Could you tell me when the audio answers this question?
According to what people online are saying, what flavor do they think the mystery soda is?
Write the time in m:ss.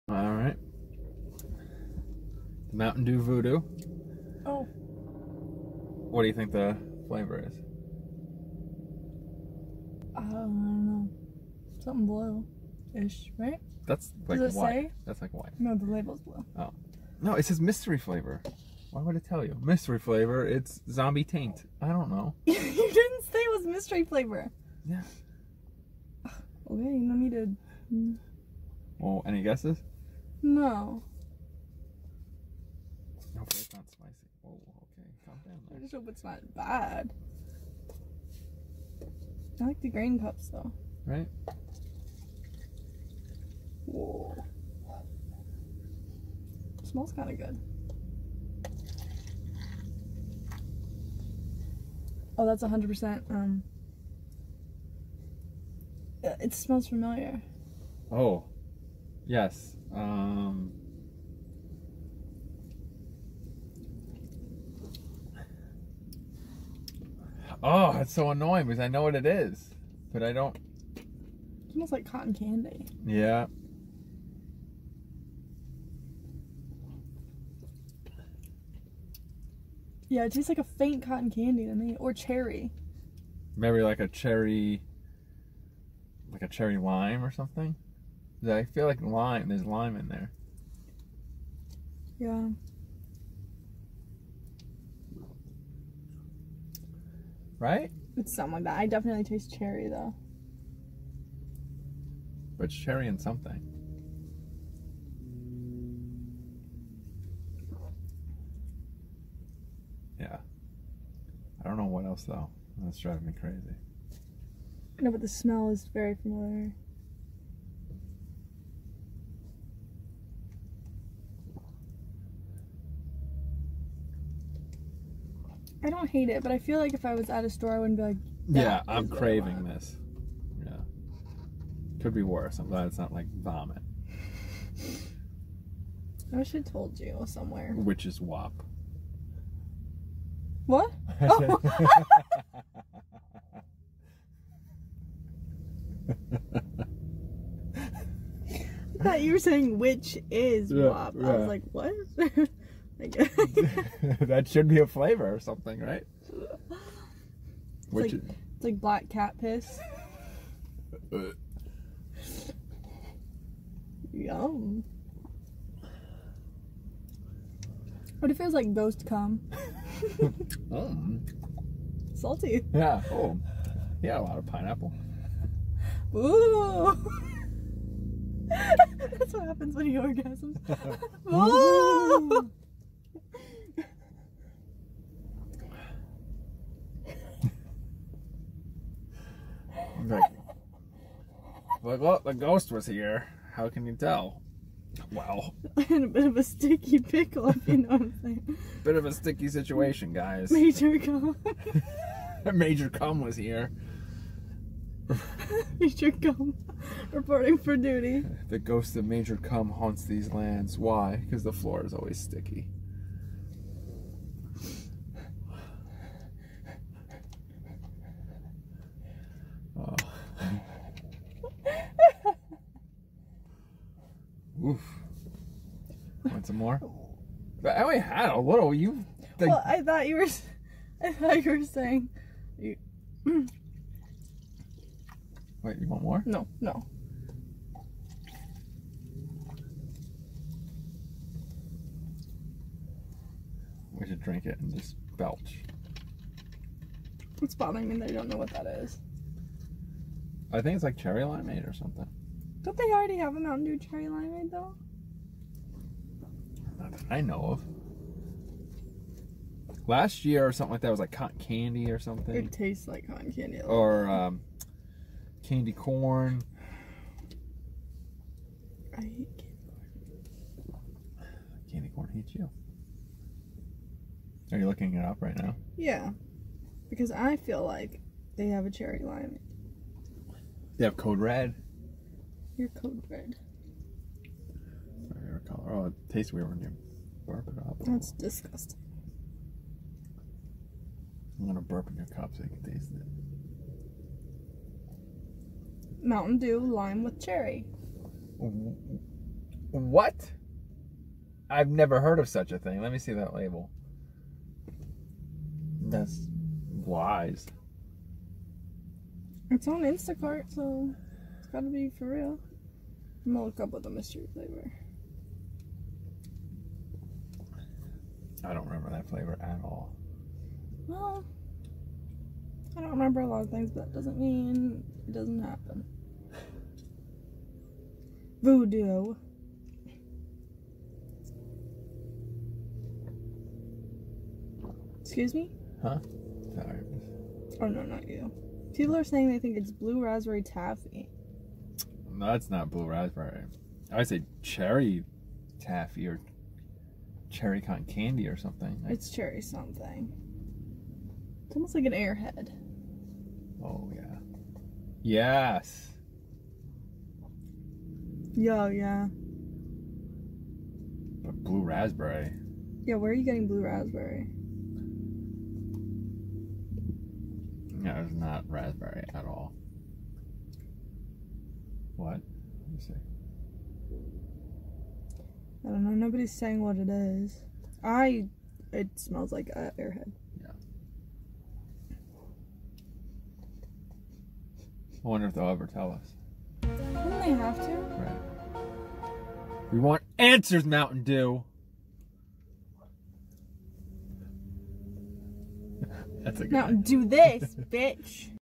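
5:39.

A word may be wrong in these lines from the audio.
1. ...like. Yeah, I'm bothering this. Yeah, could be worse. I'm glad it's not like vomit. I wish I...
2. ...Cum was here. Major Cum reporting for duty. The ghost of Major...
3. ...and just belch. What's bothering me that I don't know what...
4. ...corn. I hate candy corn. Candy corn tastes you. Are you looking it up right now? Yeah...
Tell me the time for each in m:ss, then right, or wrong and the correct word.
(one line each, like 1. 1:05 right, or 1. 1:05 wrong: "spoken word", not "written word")
1. 2:08 wrong: "craving", not "bothering"
2. 3:22 right
3. 4:04 right
4. 4:25 wrong: "hates", not "tastes".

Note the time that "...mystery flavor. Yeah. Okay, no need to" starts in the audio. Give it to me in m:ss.
0:23.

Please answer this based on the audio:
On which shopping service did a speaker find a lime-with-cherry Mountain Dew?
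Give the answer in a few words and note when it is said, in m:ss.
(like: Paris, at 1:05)
Instacart, at 5:09.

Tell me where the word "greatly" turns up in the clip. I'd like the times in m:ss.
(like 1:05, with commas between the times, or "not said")
not said.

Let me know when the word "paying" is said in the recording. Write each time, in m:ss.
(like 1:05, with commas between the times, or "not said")
not said.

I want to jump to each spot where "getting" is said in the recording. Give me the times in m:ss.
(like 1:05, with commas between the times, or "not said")
6:03.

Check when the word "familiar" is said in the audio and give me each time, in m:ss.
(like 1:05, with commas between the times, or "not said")
0:56, 1:56.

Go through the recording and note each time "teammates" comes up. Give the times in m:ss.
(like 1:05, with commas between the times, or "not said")
not said.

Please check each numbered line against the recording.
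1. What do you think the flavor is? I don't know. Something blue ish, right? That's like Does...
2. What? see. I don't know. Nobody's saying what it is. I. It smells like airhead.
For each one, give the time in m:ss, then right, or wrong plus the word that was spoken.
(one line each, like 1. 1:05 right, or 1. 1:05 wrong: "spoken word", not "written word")
1. 0:06 right
2. 6:12 right.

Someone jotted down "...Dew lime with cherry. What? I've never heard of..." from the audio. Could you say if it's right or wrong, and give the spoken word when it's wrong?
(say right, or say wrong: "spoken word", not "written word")
right.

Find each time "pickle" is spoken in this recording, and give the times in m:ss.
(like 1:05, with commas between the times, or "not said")
3:16.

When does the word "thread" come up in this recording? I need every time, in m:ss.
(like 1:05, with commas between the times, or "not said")
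not said.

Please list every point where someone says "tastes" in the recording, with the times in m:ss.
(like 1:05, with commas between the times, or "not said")
1:20, 1:39, 4:22, 4:46, 4:52.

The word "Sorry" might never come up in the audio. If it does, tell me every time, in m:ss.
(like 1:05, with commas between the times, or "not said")
5:36.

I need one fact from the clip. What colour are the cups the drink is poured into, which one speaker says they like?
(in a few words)
Green.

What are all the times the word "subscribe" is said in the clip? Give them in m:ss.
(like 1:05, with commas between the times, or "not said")
not said.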